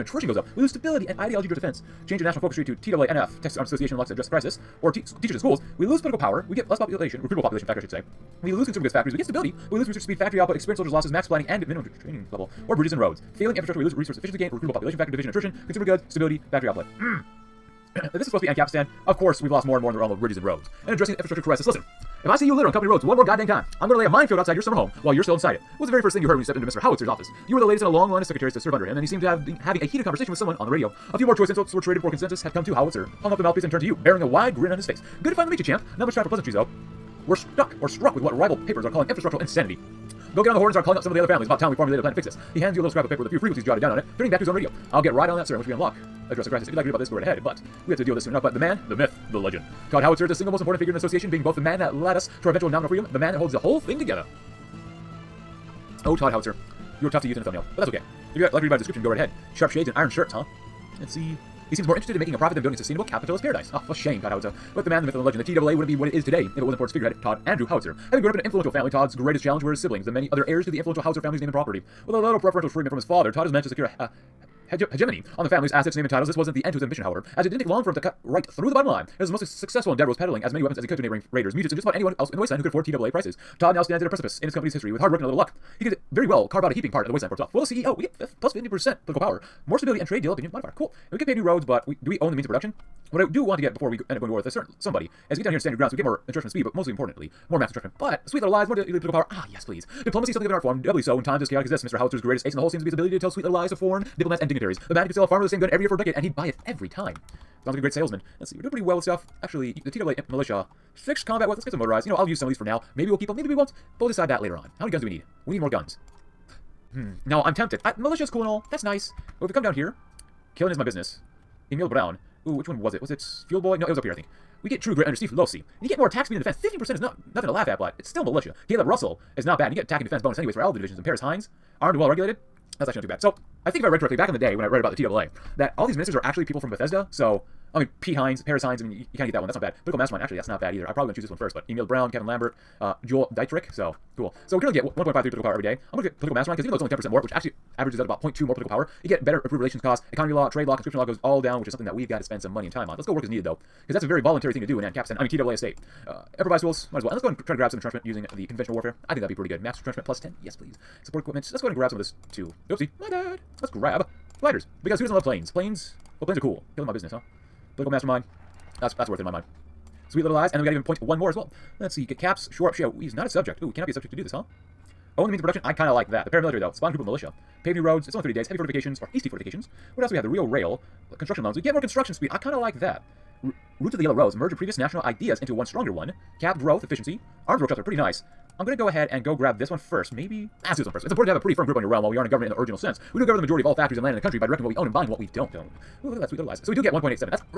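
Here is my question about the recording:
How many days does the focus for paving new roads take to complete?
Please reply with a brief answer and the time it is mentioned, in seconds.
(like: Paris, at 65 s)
30 days, at 178 s.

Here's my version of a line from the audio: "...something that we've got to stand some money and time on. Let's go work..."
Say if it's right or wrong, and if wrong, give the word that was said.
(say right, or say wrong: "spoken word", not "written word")
wrong: "spend", not "stand".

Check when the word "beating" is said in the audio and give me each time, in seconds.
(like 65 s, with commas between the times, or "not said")
not said.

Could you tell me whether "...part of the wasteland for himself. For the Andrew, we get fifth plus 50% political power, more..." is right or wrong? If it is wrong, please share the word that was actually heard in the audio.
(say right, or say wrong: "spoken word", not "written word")
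wrong: "CEO", not "Andrew".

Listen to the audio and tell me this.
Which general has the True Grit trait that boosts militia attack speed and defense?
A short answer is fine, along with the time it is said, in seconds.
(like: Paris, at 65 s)
Steve Losey, at 125 s.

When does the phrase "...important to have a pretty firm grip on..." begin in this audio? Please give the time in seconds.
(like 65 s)
191 s.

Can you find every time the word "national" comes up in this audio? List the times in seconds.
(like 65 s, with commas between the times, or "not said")
2 s, 184 s.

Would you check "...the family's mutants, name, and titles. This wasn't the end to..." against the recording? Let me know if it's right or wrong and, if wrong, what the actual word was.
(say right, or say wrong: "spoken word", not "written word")
wrong: "assets", not "mutants".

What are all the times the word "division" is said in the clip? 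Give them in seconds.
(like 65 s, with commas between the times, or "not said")
15 s, 130 s.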